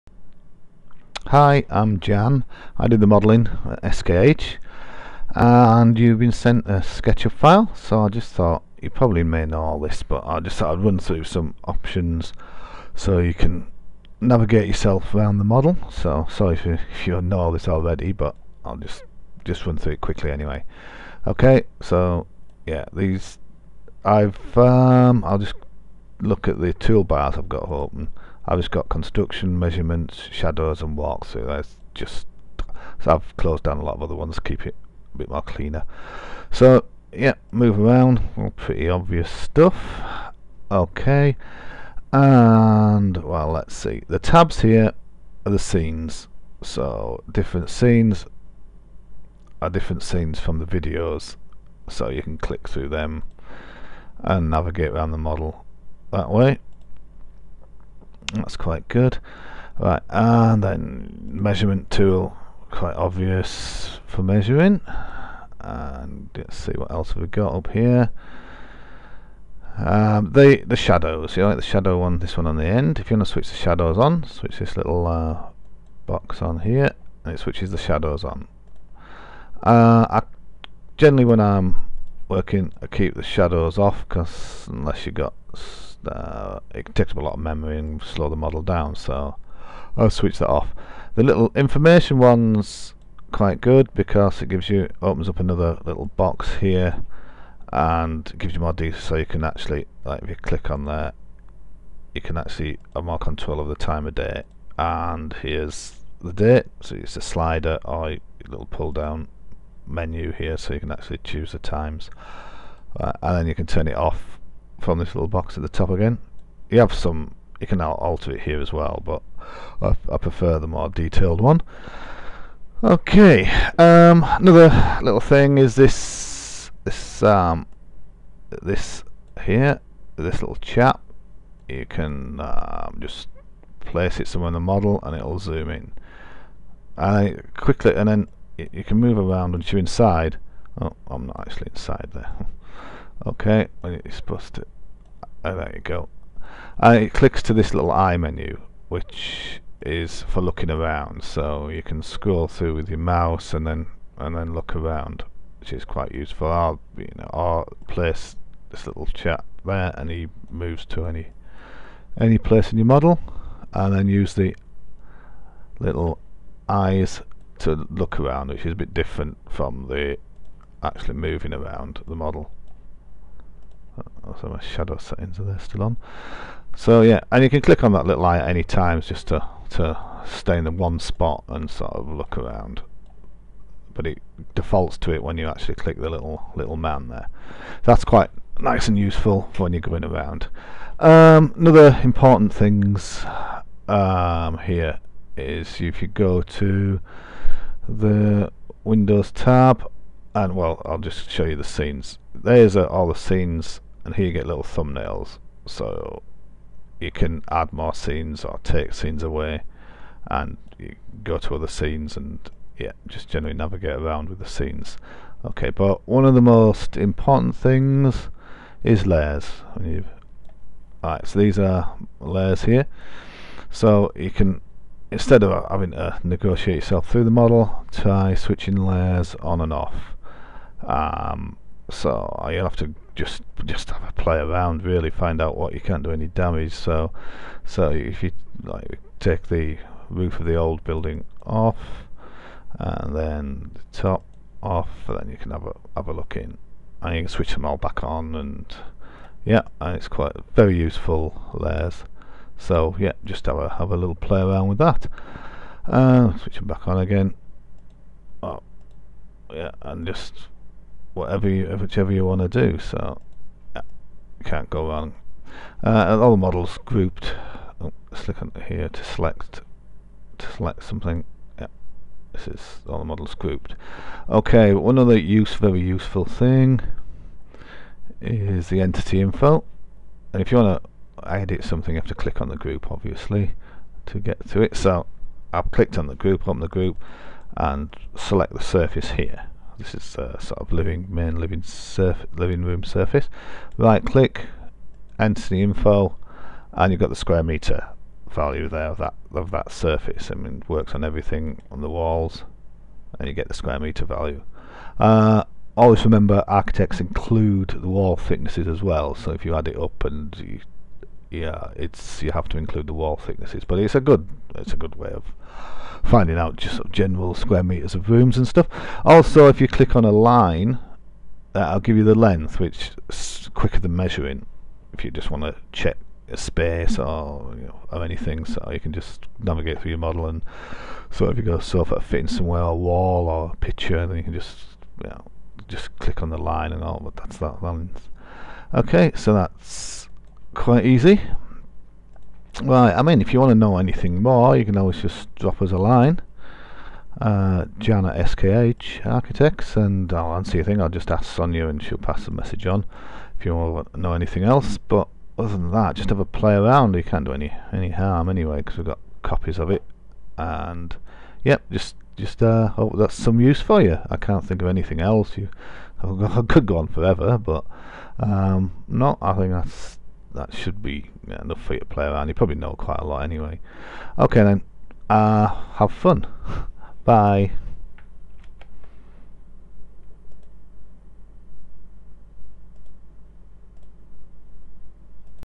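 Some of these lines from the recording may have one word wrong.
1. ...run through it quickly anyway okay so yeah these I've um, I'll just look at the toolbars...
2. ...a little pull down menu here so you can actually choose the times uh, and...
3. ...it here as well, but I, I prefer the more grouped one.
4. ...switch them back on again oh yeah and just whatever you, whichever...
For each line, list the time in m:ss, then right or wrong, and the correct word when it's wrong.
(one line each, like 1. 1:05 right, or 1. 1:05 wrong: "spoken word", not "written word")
1. 0:19 right
2. 1:48 right
3. 1:58 wrong: "detailed", not "grouped"
4. 4:16 right.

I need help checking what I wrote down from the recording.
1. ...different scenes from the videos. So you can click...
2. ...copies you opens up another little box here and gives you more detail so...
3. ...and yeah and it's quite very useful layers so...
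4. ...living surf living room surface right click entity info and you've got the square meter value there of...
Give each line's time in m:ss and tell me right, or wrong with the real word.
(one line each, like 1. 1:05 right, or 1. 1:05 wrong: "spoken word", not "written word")
1. 0:49 right
2. 1:34 wrong: "gives", not "copies"
3. 4:08 right
4. 4:51 right.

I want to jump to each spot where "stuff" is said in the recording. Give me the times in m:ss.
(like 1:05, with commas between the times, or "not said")
0:39, 5:18.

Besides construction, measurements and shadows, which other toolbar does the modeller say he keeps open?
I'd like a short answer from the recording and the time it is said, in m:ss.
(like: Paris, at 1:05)
walkthrough, at 0:30.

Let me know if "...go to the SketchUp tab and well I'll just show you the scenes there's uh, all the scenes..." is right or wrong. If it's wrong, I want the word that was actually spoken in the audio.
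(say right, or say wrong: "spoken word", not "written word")
wrong: "Windows", not "SketchUp".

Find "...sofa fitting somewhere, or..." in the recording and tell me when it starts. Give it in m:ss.
5:31.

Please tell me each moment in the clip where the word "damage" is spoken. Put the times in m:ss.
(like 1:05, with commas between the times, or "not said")
3:56.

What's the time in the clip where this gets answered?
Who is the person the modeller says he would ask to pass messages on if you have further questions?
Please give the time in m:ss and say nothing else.
5:51.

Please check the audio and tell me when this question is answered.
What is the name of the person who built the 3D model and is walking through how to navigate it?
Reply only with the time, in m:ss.
0:02.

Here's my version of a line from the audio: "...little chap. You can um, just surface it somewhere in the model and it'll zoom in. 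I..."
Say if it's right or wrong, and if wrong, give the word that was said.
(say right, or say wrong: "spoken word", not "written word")
wrong: "place", not "surface".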